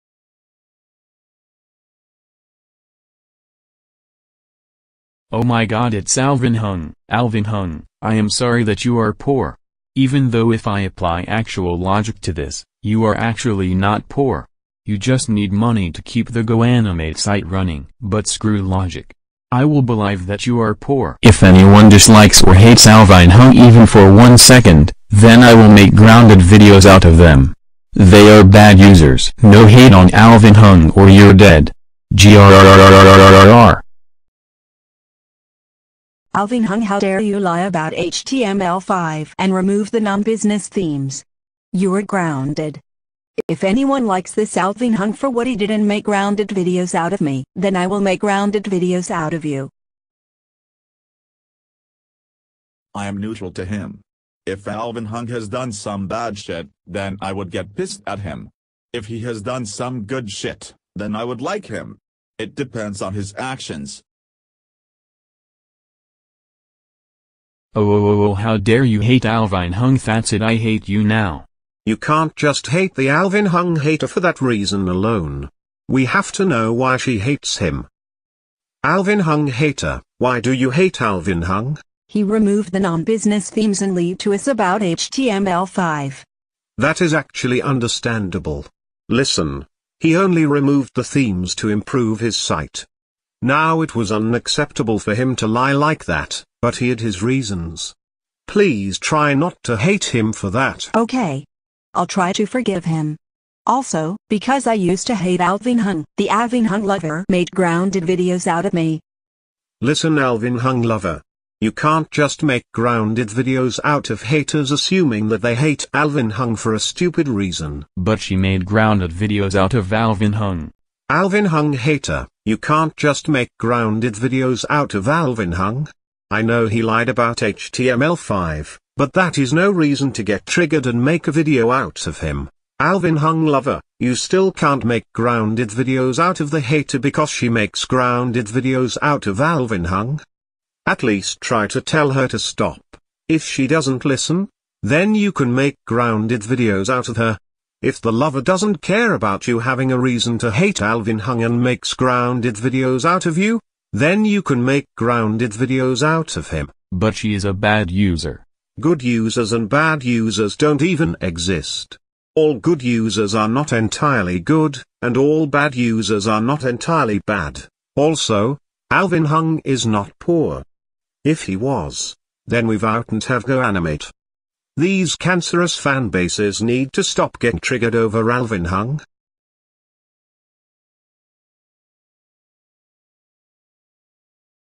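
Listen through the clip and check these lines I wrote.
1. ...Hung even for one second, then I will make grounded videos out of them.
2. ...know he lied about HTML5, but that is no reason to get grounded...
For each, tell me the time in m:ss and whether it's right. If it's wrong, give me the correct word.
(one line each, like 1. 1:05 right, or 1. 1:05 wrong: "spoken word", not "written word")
1. 0:23 right
2. 2:06 wrong: "triggered", not "grounded".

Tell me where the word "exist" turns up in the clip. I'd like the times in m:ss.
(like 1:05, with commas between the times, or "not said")
2:41.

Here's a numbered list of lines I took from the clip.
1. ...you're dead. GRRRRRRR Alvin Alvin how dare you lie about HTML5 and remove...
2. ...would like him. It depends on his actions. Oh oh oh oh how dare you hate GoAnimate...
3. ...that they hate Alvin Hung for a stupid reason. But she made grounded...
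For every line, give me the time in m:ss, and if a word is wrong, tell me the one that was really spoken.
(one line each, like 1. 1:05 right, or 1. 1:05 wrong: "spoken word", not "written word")
1. 0:31 wrong: "Hung", not "Alvin"
2. 1:01 wrong: "Alvin", not "GoAnimate"
3. 1:55 right.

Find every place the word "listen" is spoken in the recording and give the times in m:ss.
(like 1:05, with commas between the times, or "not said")
1:29, 1:49, 2:24.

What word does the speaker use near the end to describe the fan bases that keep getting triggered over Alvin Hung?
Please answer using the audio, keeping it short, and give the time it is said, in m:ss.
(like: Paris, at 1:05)
cancerous, at 2:55.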